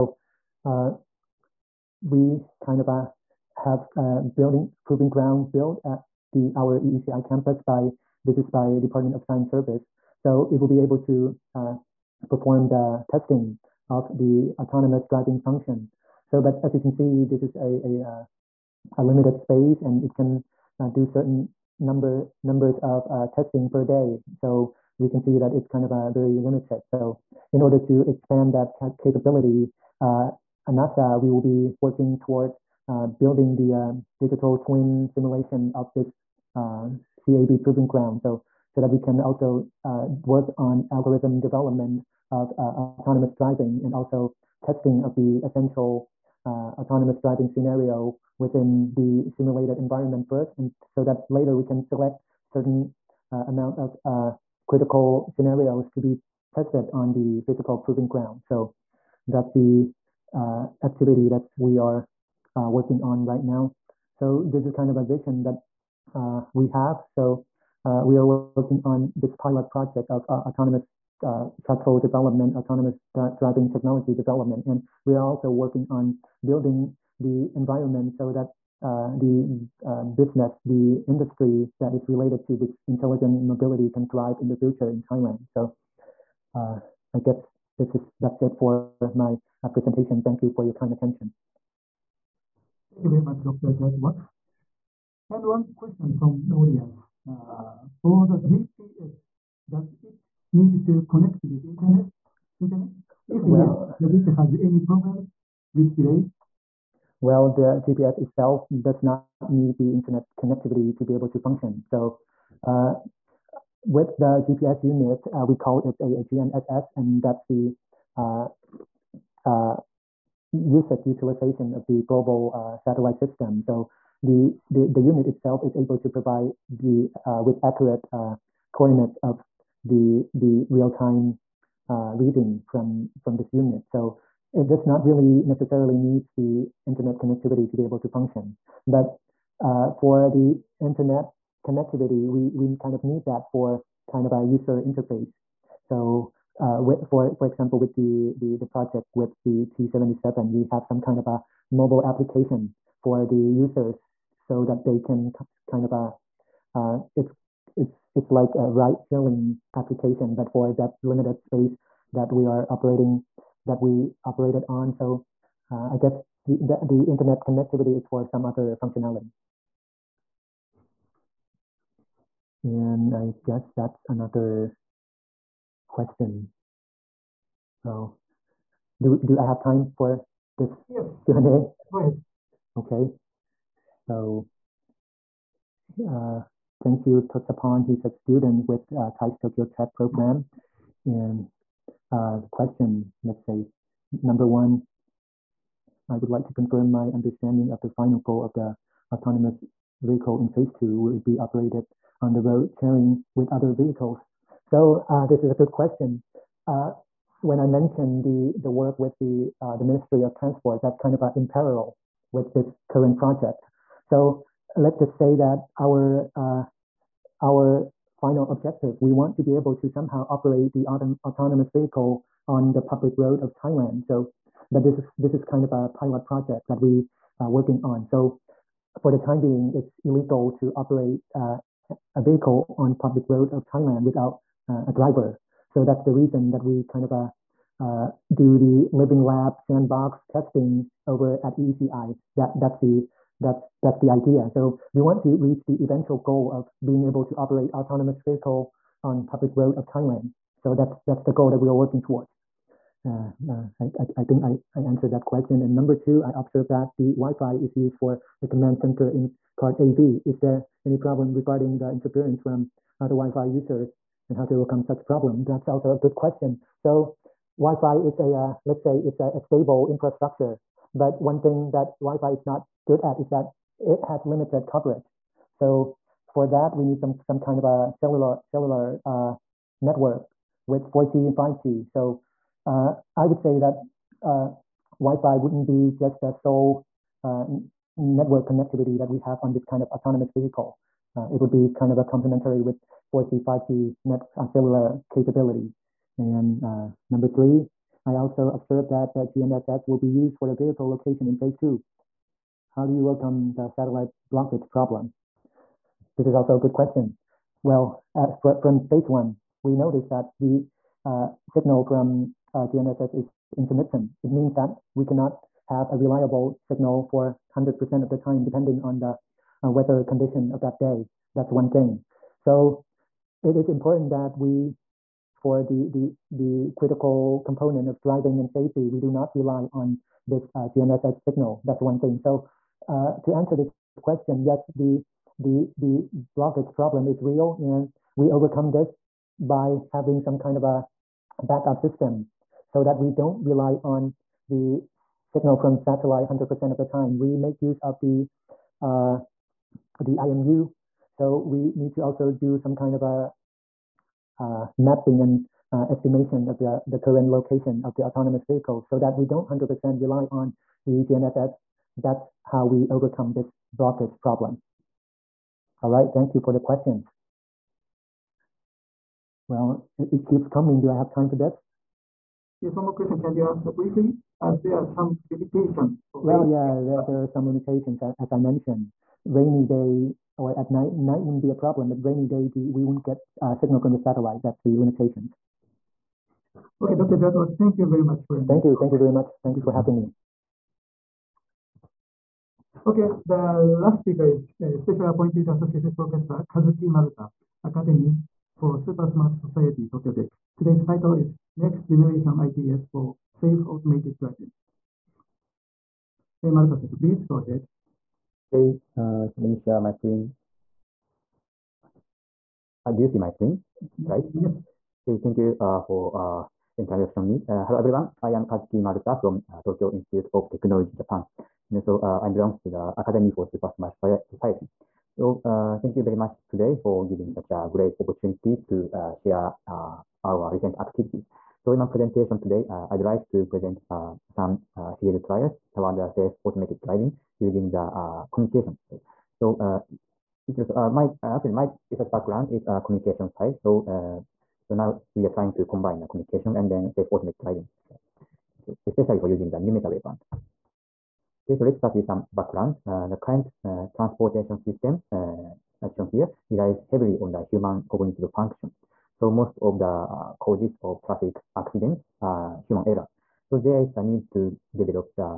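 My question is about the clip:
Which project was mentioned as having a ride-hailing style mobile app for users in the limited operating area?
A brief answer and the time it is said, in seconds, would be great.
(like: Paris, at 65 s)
T77, at 149 s.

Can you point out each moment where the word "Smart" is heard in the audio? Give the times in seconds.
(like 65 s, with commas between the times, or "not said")
399 s, 423 s.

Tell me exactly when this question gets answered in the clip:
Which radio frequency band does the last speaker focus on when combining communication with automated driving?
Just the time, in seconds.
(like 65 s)
449 s.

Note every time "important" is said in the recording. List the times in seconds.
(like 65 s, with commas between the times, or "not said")
323 s.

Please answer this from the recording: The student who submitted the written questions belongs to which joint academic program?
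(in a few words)
TAIST Tokyo Tech.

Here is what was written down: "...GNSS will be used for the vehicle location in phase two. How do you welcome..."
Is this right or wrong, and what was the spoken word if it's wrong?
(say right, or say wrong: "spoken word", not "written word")
right.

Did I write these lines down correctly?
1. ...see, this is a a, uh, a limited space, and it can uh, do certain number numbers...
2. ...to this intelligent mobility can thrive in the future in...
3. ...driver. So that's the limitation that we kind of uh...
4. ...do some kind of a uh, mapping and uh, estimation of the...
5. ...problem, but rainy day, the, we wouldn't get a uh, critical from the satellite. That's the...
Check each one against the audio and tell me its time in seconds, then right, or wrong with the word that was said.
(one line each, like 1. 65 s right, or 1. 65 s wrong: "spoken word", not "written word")
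1. 16 s right
2. 82 s right
3. 234 s wrong: "reason", not "limitation"
4. 352 s right
5. 381 s wrong: "signal", not "critical".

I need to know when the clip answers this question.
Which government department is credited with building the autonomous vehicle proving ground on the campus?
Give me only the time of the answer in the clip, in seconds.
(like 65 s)
8 s.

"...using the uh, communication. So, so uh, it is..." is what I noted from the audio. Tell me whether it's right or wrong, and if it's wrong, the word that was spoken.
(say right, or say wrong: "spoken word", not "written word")
right.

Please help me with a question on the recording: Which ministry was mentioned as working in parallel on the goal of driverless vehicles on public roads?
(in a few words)
Ministry of Transport.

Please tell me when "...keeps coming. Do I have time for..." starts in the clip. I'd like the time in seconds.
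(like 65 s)
370 s.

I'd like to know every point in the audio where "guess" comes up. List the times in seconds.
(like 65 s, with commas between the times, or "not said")
87 s, 165 s, 173 s.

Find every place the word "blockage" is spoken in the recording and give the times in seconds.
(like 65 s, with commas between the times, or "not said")
304 s, 336 s, 363 s.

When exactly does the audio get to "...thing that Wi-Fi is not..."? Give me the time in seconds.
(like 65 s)
271 s.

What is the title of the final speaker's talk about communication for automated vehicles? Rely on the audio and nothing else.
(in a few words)
Next Generation ITS for Safe Automated Driving.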